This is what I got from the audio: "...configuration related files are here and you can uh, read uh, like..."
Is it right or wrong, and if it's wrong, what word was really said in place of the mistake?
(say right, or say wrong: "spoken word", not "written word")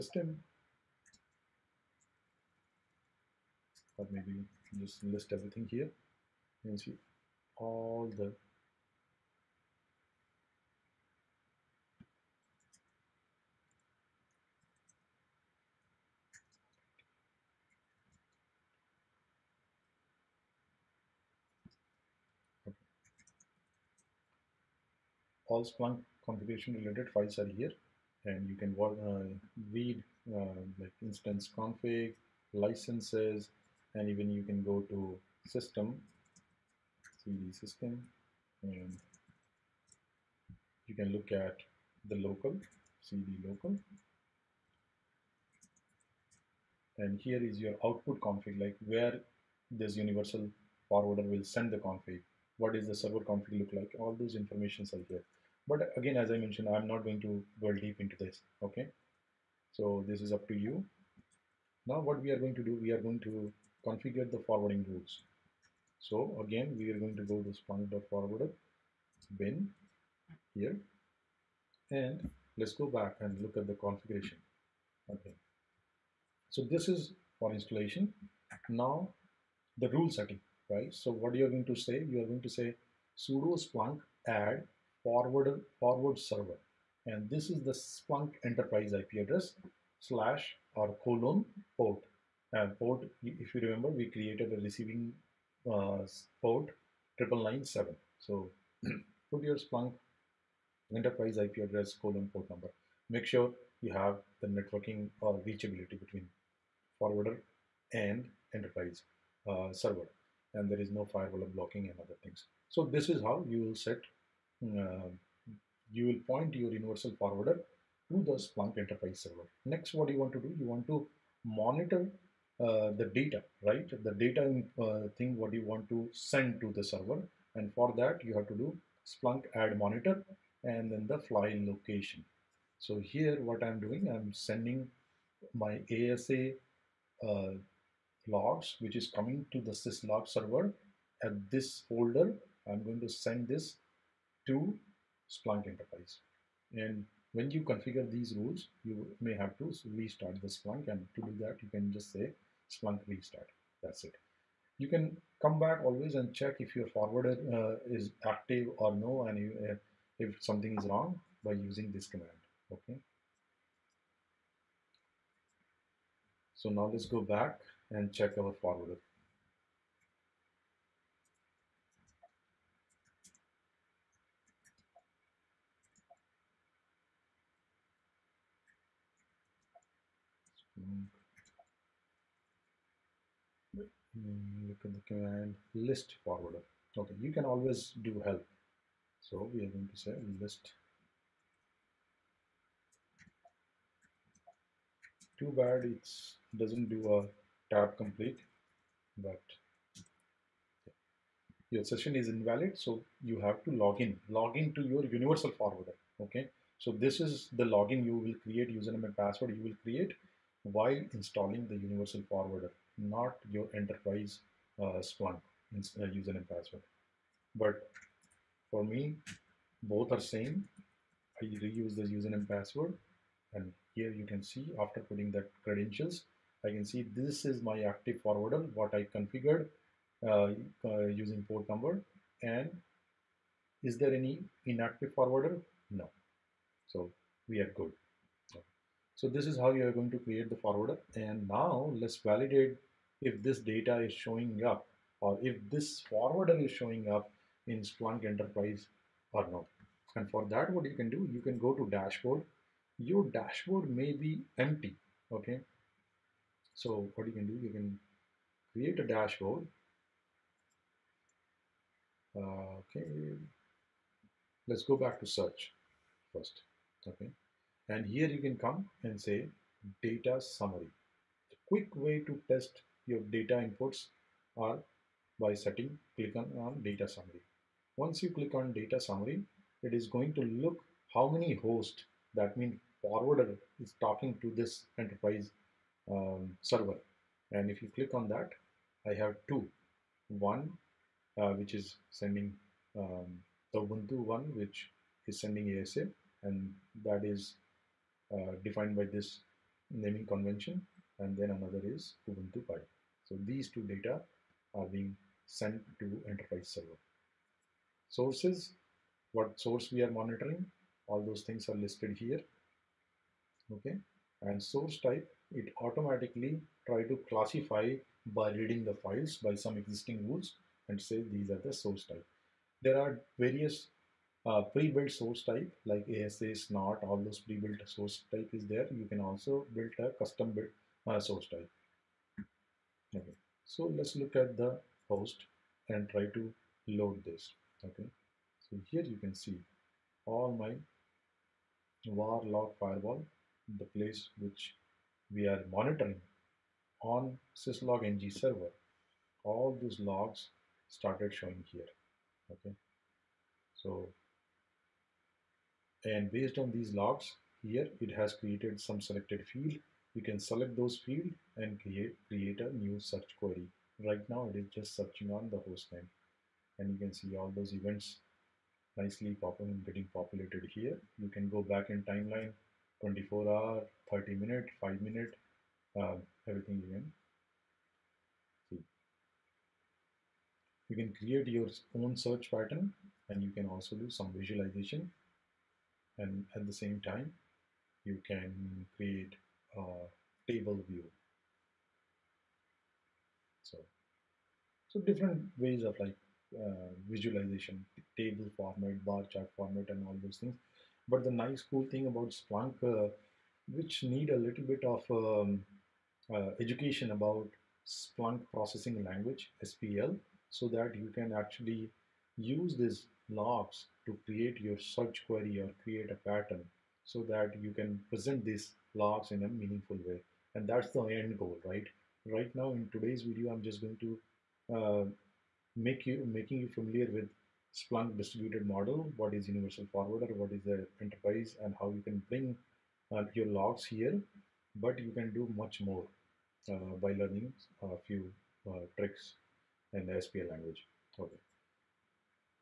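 right.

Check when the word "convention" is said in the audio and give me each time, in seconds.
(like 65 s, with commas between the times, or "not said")
300 s.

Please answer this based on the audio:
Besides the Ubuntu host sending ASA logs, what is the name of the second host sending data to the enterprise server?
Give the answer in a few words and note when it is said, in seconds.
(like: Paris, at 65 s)
Ubuntu Pi, at 302 s.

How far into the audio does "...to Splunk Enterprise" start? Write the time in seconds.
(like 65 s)
144 s.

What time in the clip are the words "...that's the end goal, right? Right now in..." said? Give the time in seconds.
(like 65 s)
420 s.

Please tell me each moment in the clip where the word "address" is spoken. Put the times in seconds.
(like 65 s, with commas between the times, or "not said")
89 s, 101 s.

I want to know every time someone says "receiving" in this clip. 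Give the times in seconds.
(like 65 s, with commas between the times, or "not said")
94 s.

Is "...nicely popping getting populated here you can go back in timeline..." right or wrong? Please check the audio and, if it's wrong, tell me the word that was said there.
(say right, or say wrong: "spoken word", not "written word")
right.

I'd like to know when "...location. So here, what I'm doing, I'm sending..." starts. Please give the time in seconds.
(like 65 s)
131 s.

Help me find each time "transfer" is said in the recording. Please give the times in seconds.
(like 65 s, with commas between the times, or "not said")
not said.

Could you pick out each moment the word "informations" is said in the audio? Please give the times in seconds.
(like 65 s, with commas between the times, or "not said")
54 s.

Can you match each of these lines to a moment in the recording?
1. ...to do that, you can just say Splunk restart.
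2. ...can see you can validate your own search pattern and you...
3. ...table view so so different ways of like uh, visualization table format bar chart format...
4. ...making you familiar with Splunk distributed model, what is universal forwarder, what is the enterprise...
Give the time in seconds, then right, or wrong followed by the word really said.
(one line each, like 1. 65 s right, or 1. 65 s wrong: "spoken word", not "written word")
1. 151 s right
2. 376 s wrong: "create", not "validate"
3. 390 s right
4. 426 s right.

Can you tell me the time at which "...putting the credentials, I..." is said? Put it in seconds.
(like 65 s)
225 s.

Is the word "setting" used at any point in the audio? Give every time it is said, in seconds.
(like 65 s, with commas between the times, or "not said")
80 s, 275 s.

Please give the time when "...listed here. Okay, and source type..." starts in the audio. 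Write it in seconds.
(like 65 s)
311 s.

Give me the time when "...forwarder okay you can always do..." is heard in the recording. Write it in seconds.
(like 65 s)
186 s.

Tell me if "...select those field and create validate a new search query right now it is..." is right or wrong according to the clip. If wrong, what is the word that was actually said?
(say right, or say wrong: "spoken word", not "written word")
wrong: "create", not "validate".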